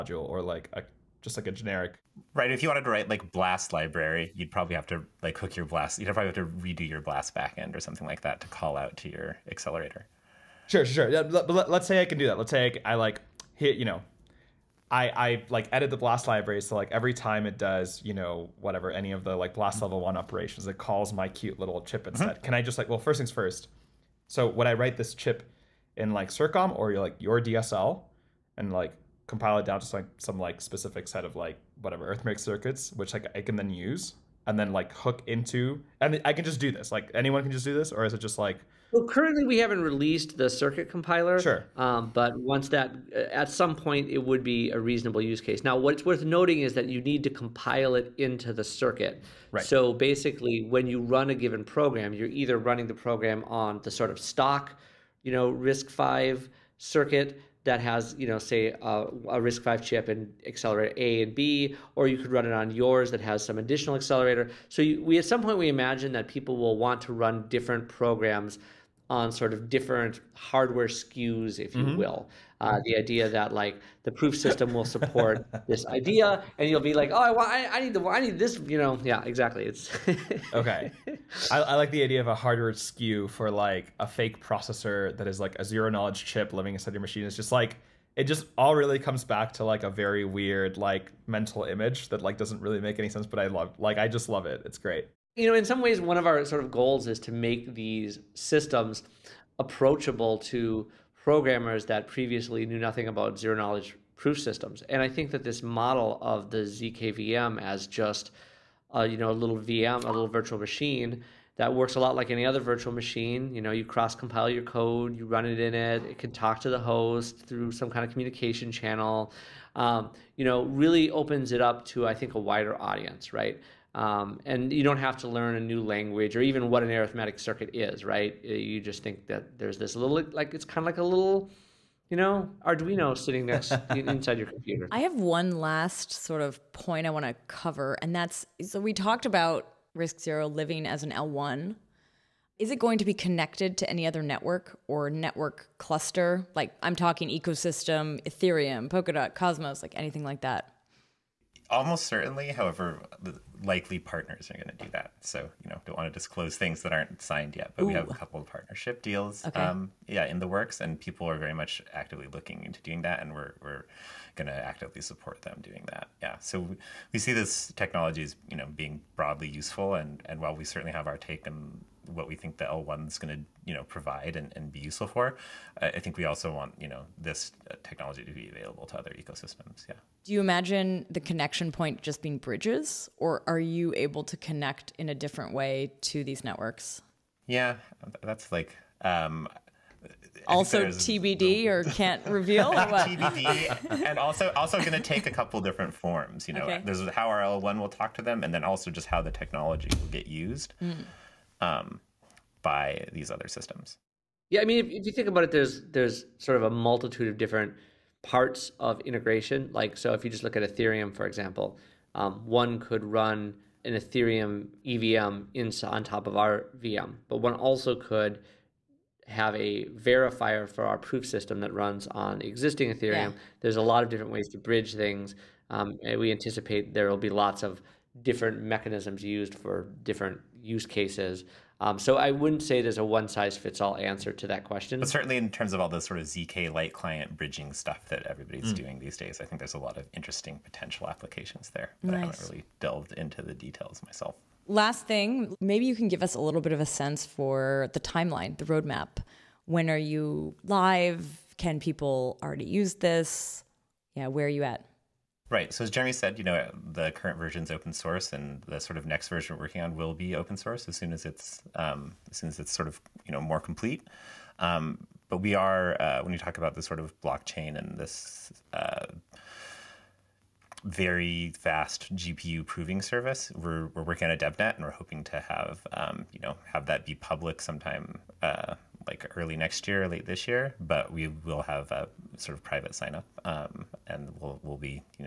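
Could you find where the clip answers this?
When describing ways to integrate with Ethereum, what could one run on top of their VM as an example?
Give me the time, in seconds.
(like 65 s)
213 s.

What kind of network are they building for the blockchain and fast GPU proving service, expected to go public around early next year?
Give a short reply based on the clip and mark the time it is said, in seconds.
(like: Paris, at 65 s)
DevNet, at 274 s.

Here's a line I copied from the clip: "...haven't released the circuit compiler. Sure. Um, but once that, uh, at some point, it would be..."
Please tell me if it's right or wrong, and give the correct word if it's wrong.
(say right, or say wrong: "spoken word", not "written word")
right.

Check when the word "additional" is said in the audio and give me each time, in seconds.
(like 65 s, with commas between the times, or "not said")
63 s.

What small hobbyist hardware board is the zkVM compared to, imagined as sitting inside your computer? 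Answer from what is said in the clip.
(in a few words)
Arduino.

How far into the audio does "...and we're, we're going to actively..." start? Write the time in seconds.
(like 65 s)
163 s.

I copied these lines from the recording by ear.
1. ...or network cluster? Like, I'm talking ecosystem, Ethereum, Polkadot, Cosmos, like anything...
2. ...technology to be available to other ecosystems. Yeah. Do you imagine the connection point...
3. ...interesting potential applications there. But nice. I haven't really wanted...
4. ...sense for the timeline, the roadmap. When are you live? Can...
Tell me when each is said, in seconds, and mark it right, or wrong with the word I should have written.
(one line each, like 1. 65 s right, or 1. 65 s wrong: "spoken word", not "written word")
1. 144 s right
2. 177 s right
3. 240 s wrong: "delved", not "wanted"
4. 246 s right.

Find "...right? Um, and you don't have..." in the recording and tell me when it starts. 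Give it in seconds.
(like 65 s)
123 s.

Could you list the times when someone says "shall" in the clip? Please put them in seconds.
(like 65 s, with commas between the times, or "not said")
not said.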